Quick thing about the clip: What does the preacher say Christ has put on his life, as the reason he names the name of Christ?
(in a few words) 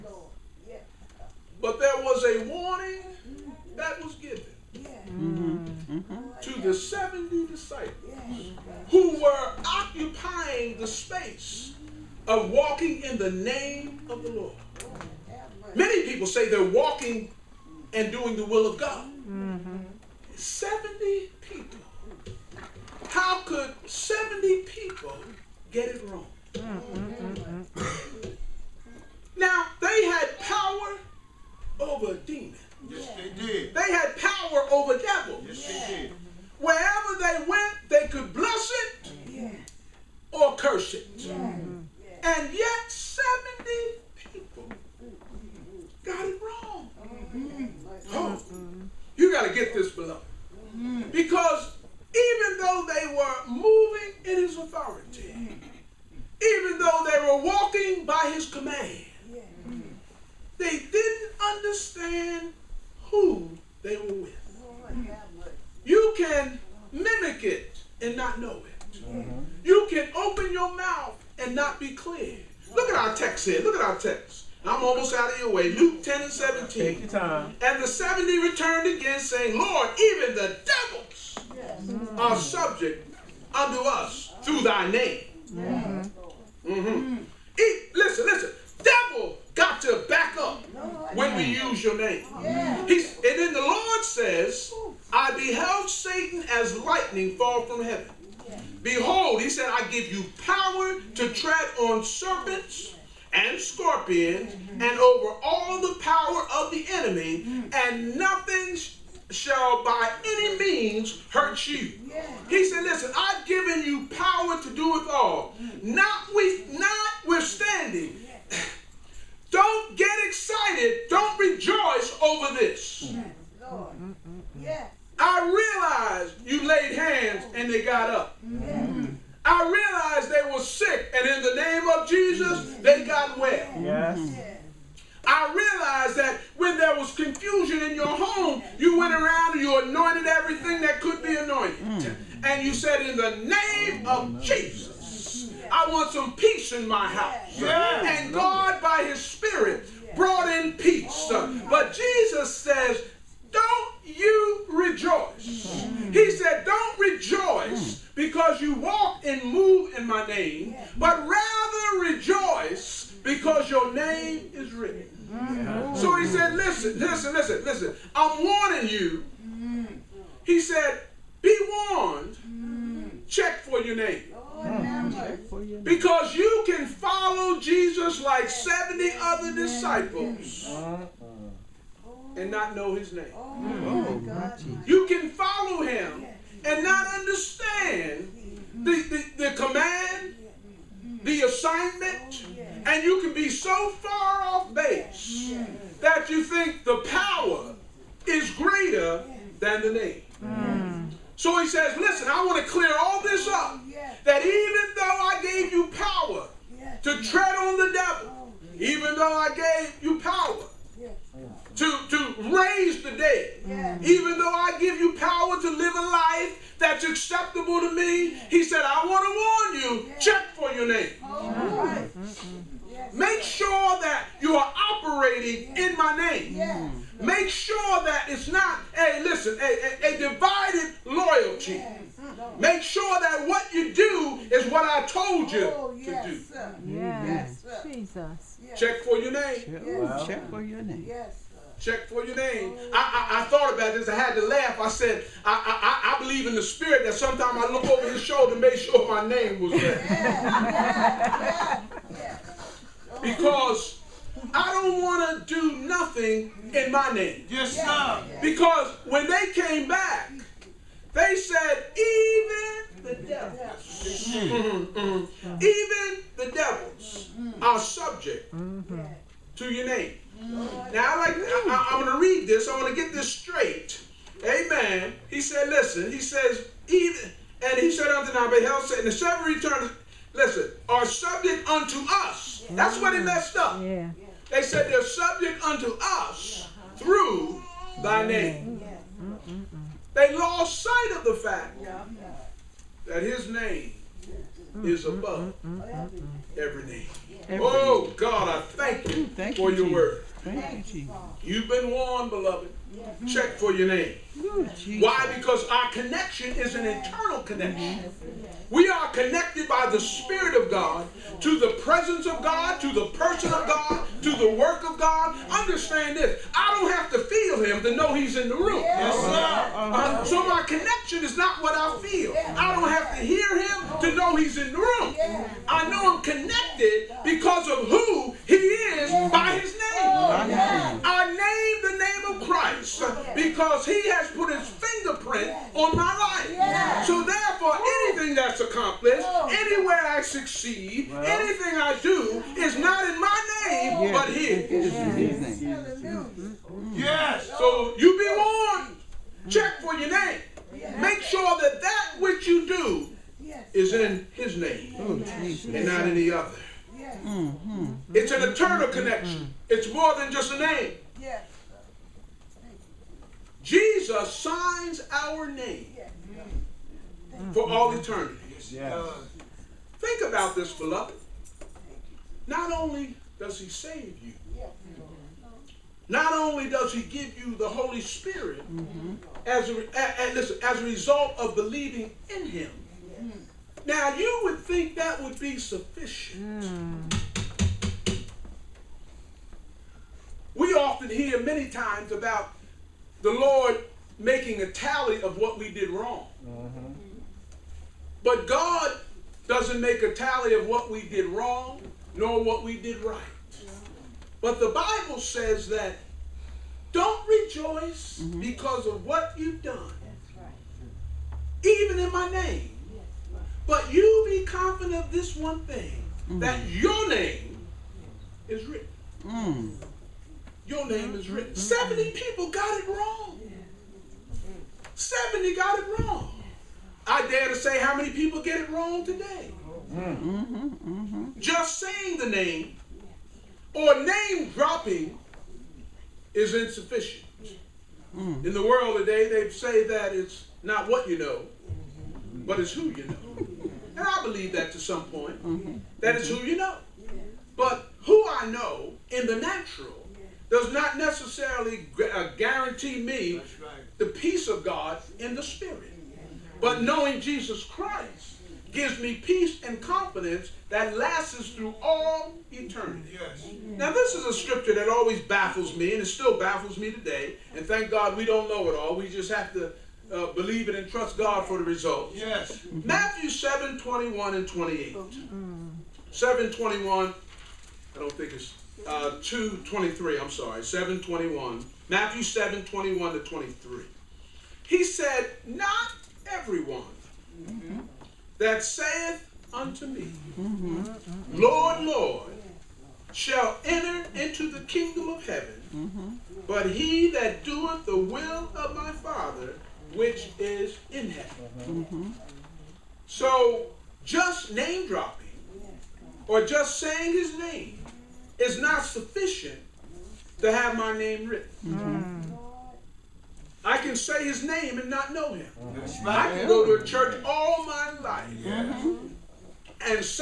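his fingerprint.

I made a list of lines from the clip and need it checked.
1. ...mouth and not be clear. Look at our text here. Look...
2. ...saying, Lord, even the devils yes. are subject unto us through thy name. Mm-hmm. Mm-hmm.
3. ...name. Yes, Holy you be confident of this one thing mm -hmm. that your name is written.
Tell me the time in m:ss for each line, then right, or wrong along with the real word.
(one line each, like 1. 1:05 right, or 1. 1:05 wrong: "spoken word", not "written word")
1. 1:10 right
2. 1:19 right
3. 6:52 wrong: "But", not "Holy".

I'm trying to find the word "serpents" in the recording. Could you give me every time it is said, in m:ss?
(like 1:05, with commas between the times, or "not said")
1:42.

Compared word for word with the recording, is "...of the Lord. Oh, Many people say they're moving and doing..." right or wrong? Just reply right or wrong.
wrong.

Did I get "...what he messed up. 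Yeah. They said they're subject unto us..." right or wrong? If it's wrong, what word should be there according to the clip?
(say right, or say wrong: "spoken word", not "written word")
right.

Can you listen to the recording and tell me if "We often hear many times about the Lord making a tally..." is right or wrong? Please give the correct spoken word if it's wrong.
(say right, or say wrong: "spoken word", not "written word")
right.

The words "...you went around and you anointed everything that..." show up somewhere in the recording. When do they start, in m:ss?
2:18.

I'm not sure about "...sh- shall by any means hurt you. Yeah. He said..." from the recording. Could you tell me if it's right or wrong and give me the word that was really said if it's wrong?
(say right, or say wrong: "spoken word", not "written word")
right.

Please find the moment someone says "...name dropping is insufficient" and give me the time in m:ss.
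7:14.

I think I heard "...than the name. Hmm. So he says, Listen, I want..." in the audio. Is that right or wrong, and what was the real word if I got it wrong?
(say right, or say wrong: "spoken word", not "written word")
right.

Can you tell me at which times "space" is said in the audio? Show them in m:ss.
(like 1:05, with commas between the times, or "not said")
0:10.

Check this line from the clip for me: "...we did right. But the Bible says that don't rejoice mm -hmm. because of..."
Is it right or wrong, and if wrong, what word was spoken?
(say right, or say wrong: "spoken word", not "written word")
right.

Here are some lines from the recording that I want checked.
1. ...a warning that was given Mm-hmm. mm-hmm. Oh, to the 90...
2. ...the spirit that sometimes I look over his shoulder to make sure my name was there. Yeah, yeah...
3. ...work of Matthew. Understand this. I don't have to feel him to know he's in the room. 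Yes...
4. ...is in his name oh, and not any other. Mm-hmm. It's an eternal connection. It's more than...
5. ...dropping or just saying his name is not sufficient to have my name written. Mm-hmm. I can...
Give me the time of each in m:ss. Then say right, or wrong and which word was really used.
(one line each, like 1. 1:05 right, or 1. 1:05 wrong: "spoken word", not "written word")
1. 0:02 wrong: "70", not "90"
2. 4:06 right
3. 5:14 wrong: "God", not "Matthew"
4. 5:53 right
5. 8:24 right.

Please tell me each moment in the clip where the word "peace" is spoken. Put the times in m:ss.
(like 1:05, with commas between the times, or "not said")
2:26, 2:30, 7:34, 7:39.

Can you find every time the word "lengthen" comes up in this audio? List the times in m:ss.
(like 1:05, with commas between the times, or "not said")
not said.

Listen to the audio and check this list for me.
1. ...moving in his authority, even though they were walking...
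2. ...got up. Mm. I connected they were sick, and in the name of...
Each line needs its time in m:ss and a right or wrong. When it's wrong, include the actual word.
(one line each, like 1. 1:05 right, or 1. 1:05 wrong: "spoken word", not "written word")
1. 0:53 right
2. 2:07 wrong: "realized", not "connected".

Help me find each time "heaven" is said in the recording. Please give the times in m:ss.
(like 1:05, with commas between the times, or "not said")
1:37, 8:15, 8:21.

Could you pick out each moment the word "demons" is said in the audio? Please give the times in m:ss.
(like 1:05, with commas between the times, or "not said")
0:32.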